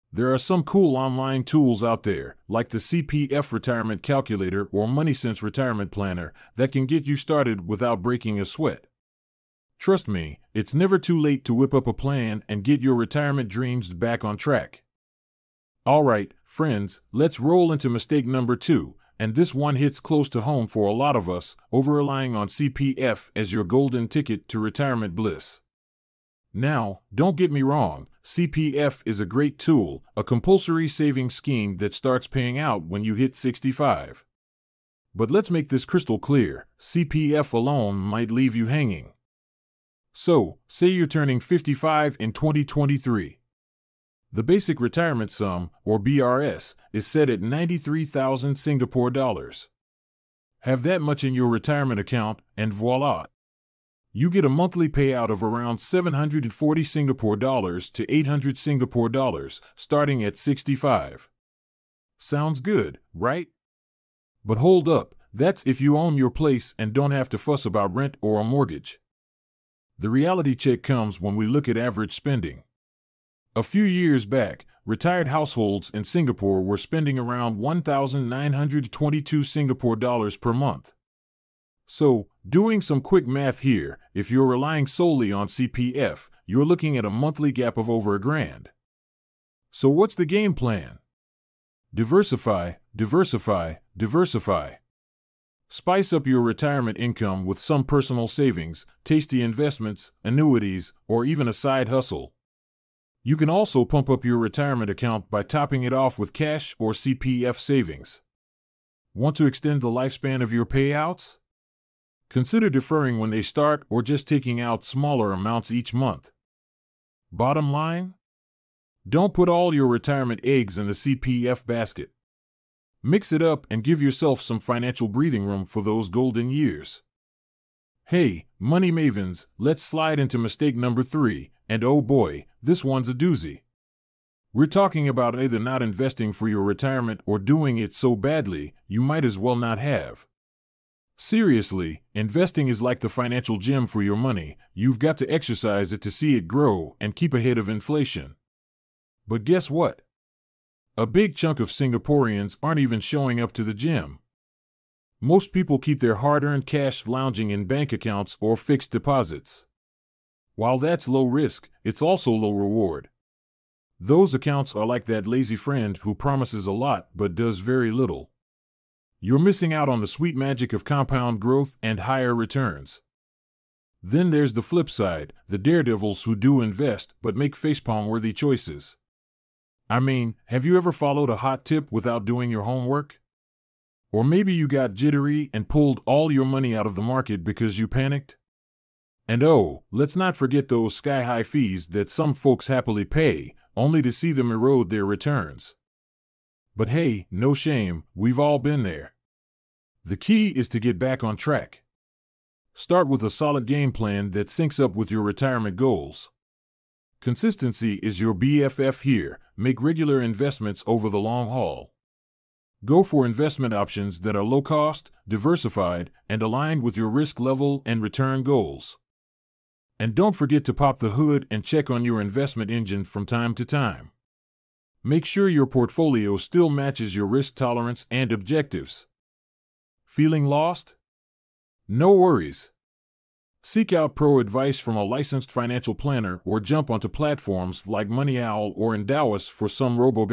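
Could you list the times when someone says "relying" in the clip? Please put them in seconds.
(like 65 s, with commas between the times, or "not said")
21 s, 84 s.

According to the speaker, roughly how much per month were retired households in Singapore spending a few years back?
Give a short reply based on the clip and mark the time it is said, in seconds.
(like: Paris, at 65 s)
1,922 Singapore dollars, at 77 s.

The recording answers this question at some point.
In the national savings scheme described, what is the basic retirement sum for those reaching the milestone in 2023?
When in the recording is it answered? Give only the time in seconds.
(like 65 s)
47 s.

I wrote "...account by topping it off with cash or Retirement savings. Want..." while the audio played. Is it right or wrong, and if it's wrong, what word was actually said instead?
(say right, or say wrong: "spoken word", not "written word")
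wrong: "CPF", not "Retirement".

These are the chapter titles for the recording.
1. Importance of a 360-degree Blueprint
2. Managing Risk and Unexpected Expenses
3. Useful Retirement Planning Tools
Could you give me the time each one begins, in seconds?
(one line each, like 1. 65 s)
1. 20 s
2. 110 s
3. 185 s.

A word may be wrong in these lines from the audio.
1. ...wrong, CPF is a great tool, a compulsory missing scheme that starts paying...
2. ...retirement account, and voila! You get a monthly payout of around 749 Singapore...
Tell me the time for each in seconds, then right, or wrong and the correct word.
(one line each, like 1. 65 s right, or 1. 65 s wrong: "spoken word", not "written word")
1. 27 s wrong: "saving", not "missing"
2. 51 s wrong: "740", not "749".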